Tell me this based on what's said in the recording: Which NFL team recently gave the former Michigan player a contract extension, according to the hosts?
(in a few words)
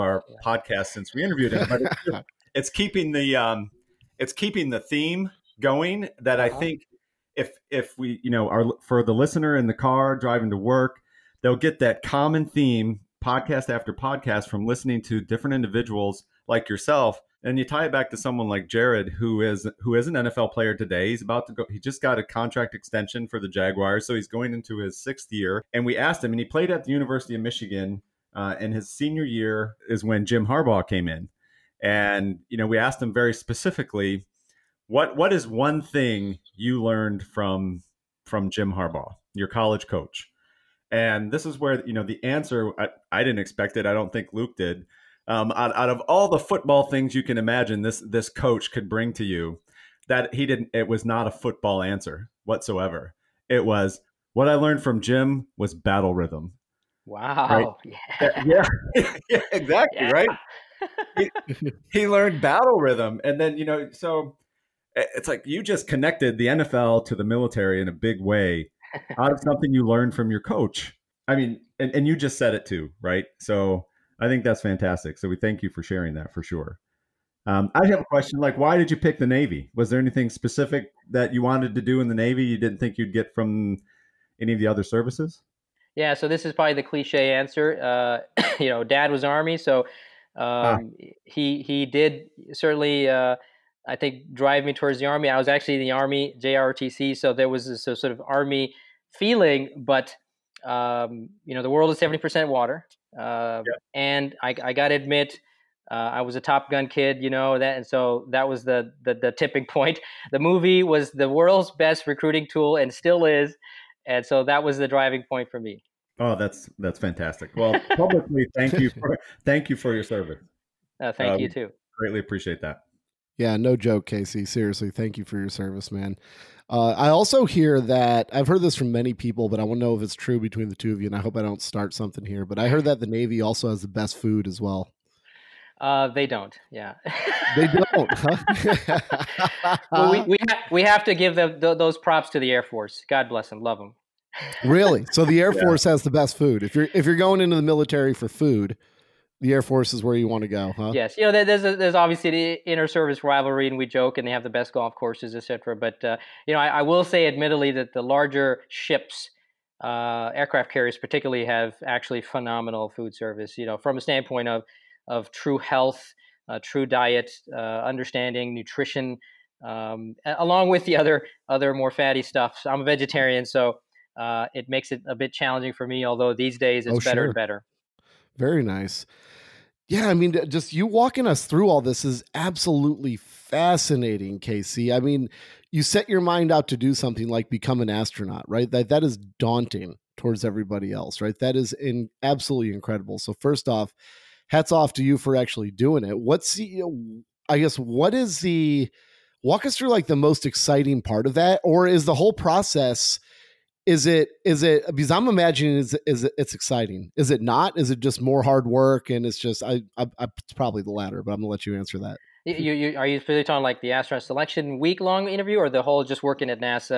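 Jaguars.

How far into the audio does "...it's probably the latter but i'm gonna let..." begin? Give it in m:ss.
3:30.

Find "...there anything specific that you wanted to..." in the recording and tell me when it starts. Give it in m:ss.
1:19.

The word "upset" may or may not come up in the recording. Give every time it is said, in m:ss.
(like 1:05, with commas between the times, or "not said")
not said.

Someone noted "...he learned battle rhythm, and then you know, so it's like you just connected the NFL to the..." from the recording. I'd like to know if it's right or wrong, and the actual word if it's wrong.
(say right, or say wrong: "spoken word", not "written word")
right.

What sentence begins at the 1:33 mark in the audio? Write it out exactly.
Uh, I think drive me towards the army.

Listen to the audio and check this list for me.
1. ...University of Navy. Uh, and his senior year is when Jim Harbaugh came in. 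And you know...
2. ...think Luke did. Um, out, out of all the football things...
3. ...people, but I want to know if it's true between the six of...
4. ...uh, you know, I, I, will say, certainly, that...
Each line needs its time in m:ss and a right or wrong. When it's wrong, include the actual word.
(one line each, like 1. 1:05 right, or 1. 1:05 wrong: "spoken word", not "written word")
1. 0:26 wrong: "Michigan", not "Navy"
2. 0:44 right
3. 2:09 wrong: "two", not "six"
4. 2:36 wrong: "admittedly", not "certainly".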